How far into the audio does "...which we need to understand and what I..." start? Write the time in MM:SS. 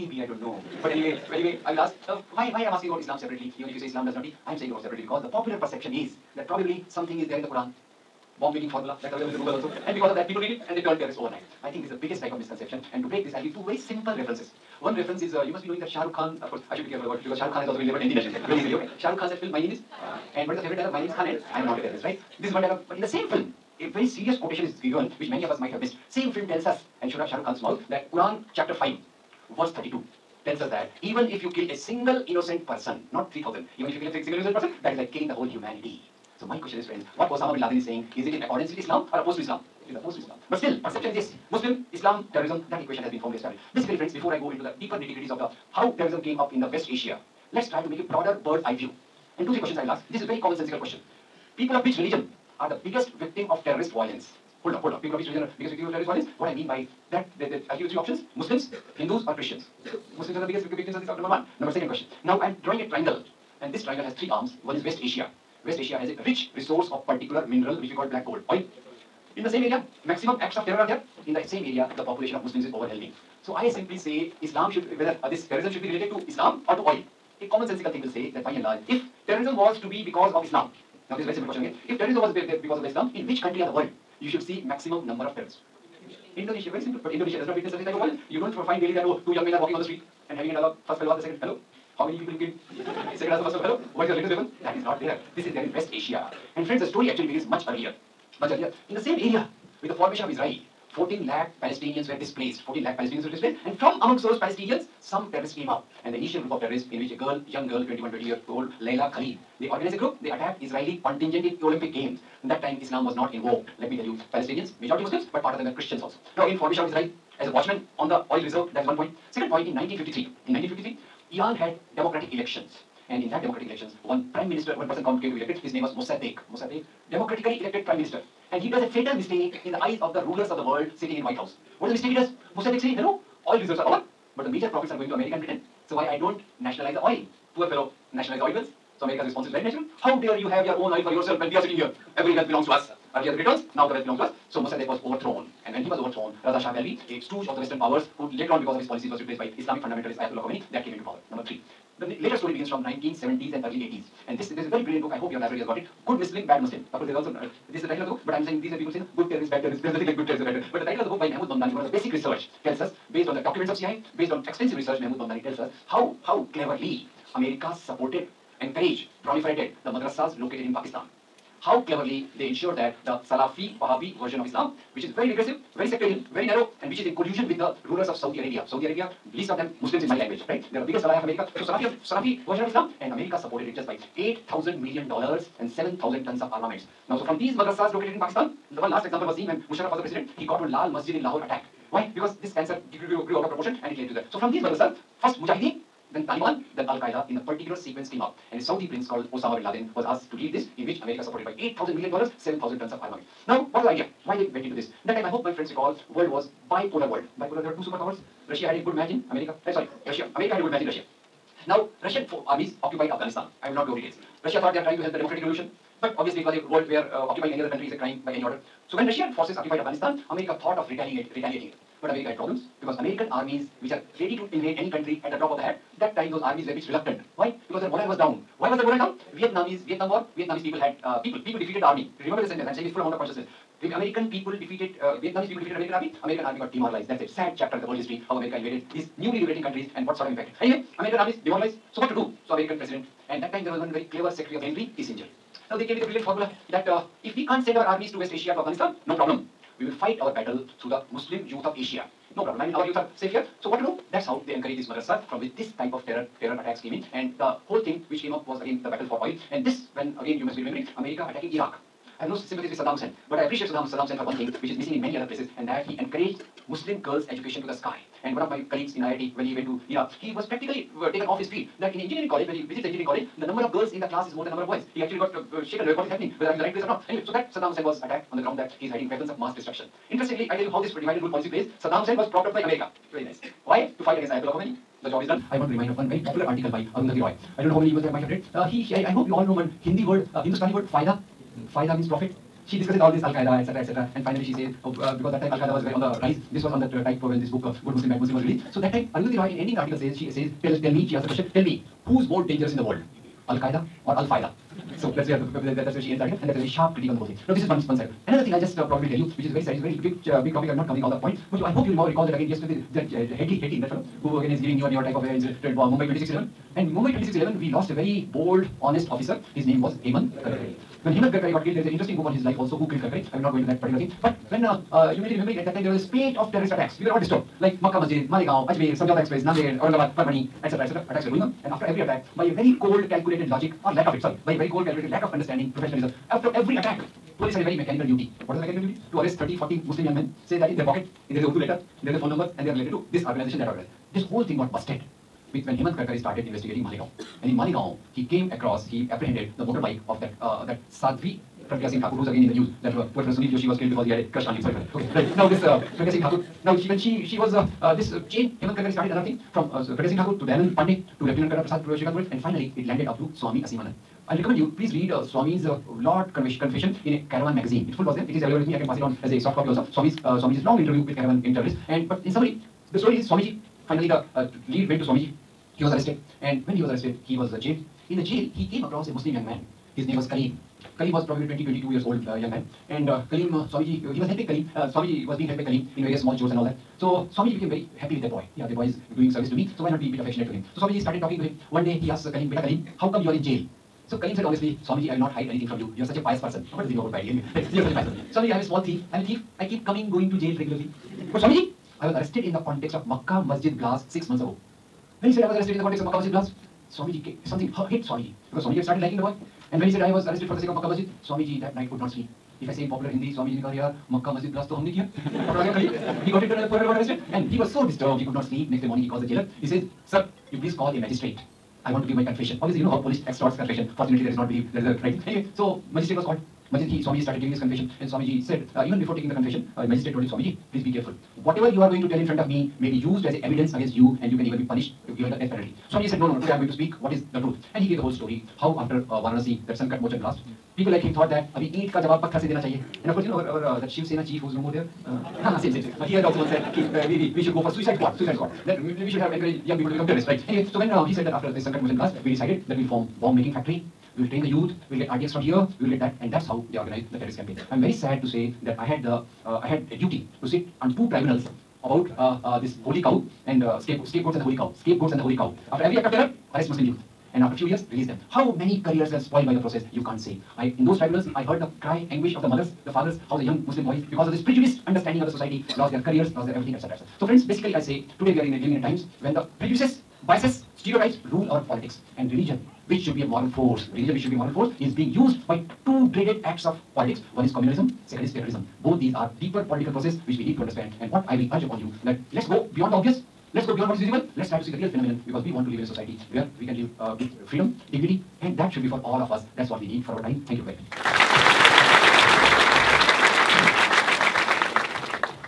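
08:10.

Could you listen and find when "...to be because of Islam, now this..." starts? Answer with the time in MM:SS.
01:19.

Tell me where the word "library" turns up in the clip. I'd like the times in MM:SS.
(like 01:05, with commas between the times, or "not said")
02:35.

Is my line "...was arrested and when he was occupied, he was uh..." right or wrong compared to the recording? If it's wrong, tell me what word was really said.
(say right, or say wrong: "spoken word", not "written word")
wrong: "arrested", not "occupied".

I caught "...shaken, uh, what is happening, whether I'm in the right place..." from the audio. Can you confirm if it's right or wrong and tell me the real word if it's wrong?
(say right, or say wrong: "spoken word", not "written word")
right.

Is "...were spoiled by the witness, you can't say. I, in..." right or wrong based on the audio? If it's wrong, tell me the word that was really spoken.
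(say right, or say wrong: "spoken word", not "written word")
wrong: "process", not "witness".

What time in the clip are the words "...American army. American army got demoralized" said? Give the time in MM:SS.
03:55.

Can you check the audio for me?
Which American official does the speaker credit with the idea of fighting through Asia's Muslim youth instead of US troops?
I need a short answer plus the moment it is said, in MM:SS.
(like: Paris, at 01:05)
Henry Kissinger, at 04:04.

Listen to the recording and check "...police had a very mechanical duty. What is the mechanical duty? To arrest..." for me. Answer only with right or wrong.
right.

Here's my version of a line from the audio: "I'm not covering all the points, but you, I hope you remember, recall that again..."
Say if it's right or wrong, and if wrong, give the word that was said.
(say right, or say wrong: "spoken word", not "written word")
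right.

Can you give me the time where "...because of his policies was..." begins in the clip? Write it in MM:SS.
02:28.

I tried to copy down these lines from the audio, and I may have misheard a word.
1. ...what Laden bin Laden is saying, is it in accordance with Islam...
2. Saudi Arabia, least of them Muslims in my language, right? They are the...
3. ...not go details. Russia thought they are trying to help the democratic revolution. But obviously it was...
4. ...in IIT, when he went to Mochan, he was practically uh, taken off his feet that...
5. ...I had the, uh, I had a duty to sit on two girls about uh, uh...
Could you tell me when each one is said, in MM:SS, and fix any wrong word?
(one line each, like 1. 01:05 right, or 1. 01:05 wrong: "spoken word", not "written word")
1. 00:37 wrong: "Osama", not "Laden"
2. 02:58 right
3. 03:33 right
4. 04:28 wrong: "Iraq", not "Mochan"
5. 07:38 wrong: "tribunals", not "girls".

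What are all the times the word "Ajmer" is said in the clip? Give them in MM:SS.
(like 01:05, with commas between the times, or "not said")
05:28.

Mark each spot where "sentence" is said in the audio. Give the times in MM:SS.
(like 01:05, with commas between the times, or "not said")
03:52.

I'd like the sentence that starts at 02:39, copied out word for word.
There is nothing like good terrorists or bad terrorists.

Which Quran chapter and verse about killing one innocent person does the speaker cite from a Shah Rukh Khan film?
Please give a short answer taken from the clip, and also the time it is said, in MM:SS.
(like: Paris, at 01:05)
Chapter 5 verse 32, at 00:28.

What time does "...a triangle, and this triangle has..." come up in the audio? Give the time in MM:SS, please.
01:02.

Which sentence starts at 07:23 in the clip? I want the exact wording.
And of course, you know, our, our uh, that Shiv Sena chief who's no more there, uh, same, same, same.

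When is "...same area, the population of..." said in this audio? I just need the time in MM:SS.
01:11.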